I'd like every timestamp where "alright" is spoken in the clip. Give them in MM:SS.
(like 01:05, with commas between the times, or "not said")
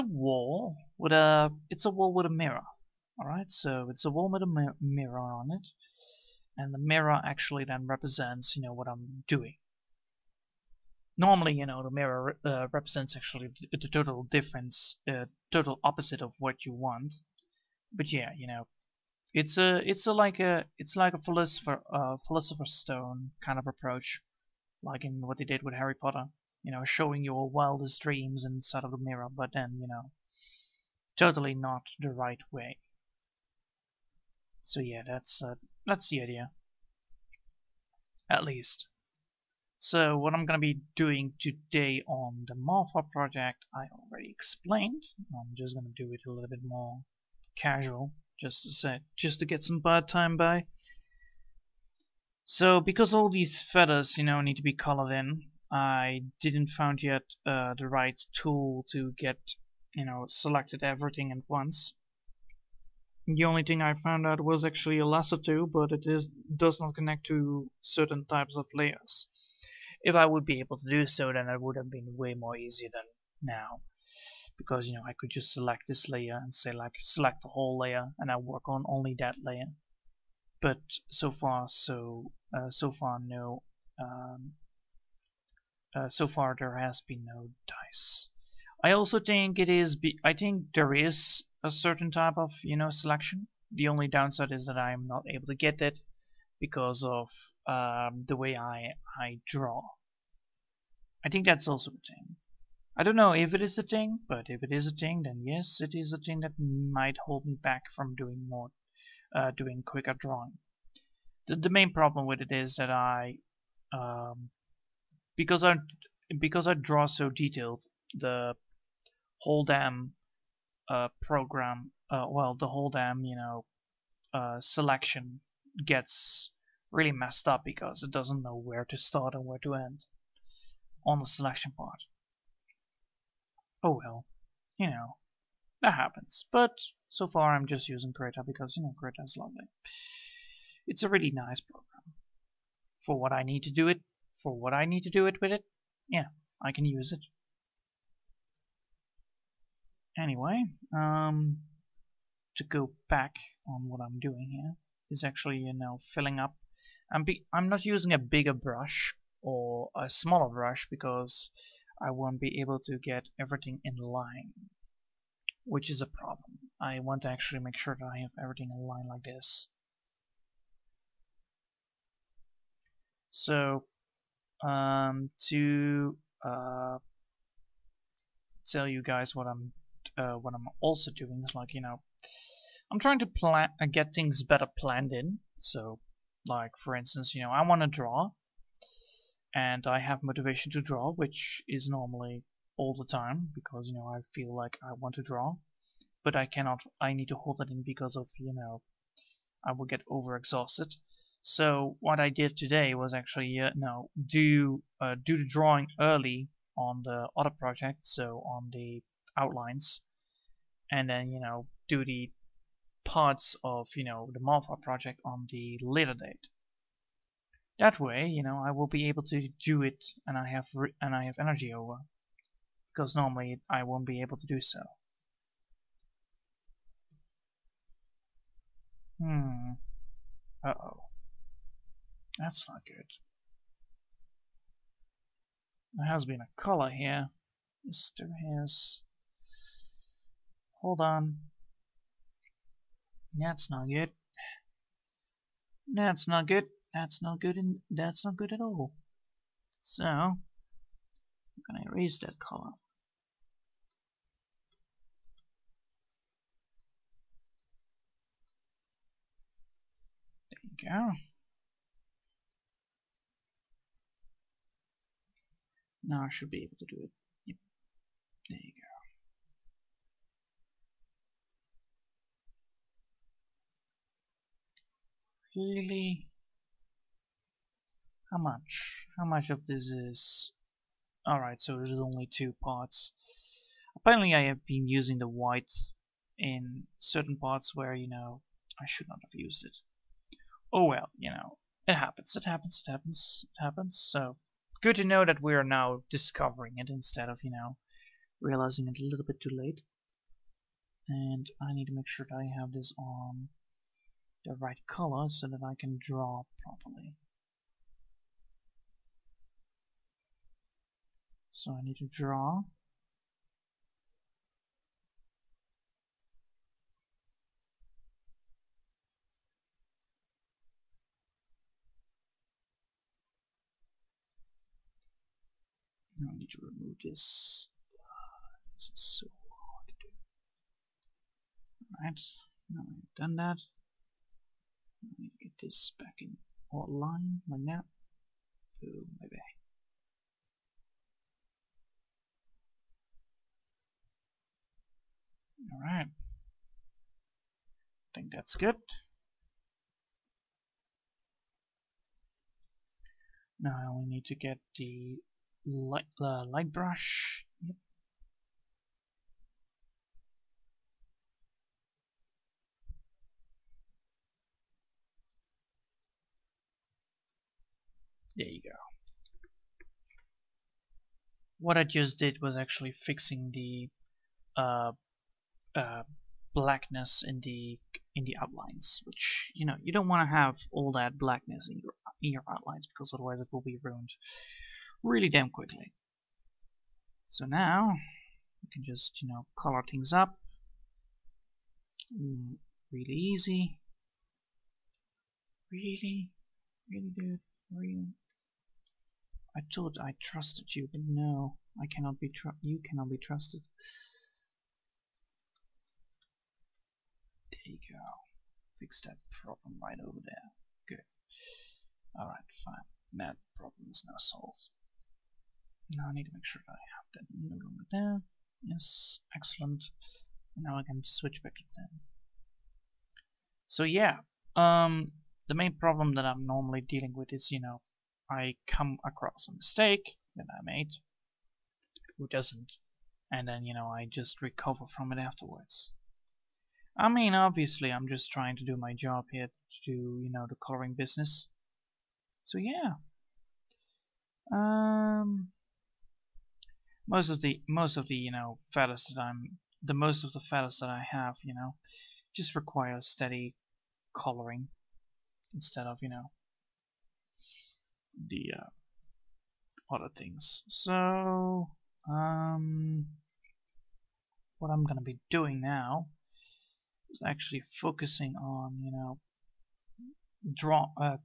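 04:41, 05:31, 05:45, 06:52.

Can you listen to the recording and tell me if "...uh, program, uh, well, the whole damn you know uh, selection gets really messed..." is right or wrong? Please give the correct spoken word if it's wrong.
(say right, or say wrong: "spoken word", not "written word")
right.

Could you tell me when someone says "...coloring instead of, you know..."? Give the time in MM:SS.
07:34.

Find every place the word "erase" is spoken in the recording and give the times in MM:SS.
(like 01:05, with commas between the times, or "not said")
04:11.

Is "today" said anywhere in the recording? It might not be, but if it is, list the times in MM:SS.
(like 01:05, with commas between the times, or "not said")
00:41, 03:22.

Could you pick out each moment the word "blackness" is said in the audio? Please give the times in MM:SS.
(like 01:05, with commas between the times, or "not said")
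06:16, 06:21.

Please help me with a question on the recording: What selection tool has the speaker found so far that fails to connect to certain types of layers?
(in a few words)
Lasso tool.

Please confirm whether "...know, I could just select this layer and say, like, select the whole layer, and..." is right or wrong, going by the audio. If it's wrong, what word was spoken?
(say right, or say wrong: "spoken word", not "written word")
right.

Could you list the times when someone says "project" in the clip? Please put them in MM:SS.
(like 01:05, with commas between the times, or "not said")
00:43, 03:27, 03:34.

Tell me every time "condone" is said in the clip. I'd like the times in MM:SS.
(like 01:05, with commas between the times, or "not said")
not said.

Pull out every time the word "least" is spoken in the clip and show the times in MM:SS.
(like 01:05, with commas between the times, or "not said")
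00:38.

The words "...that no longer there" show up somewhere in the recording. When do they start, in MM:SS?
06:57.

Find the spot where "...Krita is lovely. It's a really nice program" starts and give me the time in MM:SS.
02:19.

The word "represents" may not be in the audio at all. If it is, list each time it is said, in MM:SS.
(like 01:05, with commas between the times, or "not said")
00:07, 00:12.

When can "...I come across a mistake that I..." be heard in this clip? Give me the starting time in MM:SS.
07:08.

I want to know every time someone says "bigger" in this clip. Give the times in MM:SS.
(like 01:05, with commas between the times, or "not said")
02:38.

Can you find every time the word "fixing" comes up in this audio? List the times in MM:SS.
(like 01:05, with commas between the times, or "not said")
06:12.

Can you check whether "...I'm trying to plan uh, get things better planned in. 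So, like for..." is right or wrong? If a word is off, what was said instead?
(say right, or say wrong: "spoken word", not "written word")
right.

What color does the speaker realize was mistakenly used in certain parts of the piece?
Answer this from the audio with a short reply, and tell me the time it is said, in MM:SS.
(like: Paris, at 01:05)
White, at 04:45.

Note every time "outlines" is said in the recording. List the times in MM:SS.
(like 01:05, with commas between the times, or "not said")
03:29, 06:18, 06:22.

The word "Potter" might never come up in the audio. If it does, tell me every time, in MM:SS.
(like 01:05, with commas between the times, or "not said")
00:25.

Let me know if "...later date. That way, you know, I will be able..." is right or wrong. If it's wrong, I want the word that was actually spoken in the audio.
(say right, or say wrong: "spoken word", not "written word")
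right.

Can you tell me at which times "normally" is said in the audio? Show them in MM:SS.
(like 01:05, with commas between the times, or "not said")
00:11, 03:11, 03:43, 07:06.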